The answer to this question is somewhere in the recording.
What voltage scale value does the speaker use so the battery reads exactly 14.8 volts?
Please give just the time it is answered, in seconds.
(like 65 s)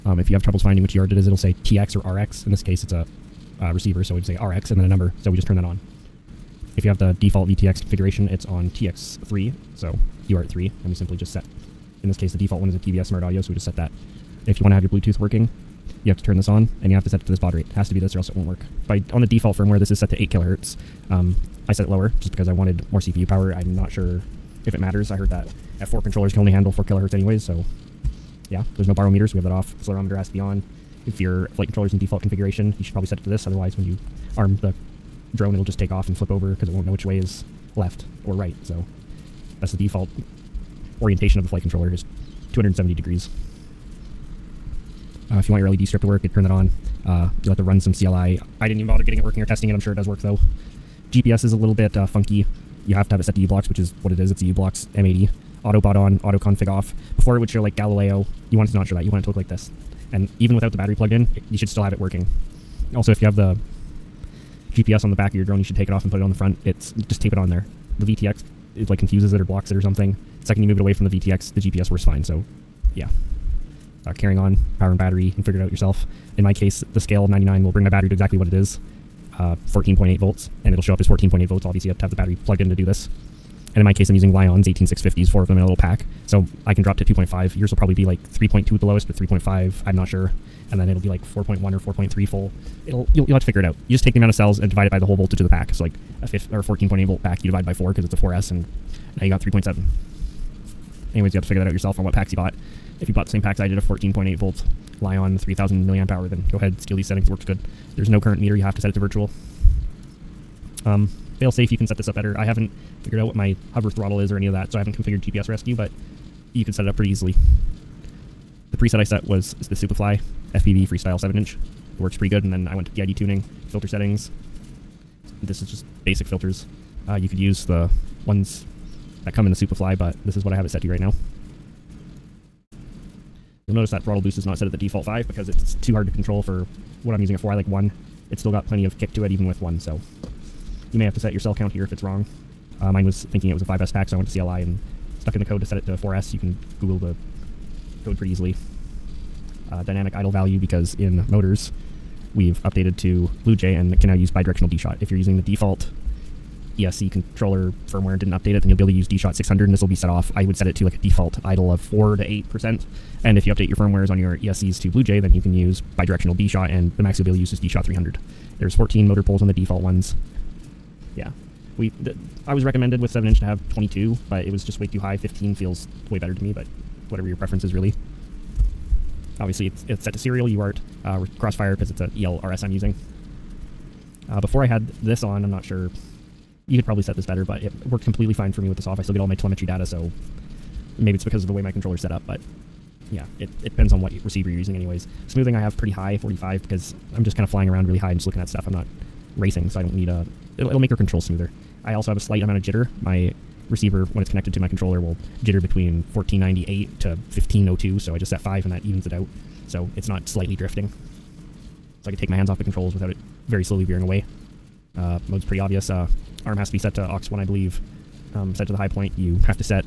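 76 s.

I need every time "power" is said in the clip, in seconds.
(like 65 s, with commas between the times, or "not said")
23 s, 74 s.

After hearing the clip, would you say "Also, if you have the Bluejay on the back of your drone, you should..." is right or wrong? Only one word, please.
wrong.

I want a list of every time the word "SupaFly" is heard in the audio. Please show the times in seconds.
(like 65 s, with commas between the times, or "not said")
119 s, 129 s.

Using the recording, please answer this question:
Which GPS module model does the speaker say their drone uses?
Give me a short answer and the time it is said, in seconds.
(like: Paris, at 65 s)
u-blox M80, at 54 s.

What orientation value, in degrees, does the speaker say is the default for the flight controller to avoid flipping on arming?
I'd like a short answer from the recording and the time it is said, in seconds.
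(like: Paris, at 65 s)
270, at 42 s.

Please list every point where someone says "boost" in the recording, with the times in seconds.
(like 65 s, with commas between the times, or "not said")
134 s.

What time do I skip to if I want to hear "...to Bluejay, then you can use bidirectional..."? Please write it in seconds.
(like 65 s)
164 s.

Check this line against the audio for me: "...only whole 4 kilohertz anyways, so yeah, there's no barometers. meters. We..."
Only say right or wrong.
wrong.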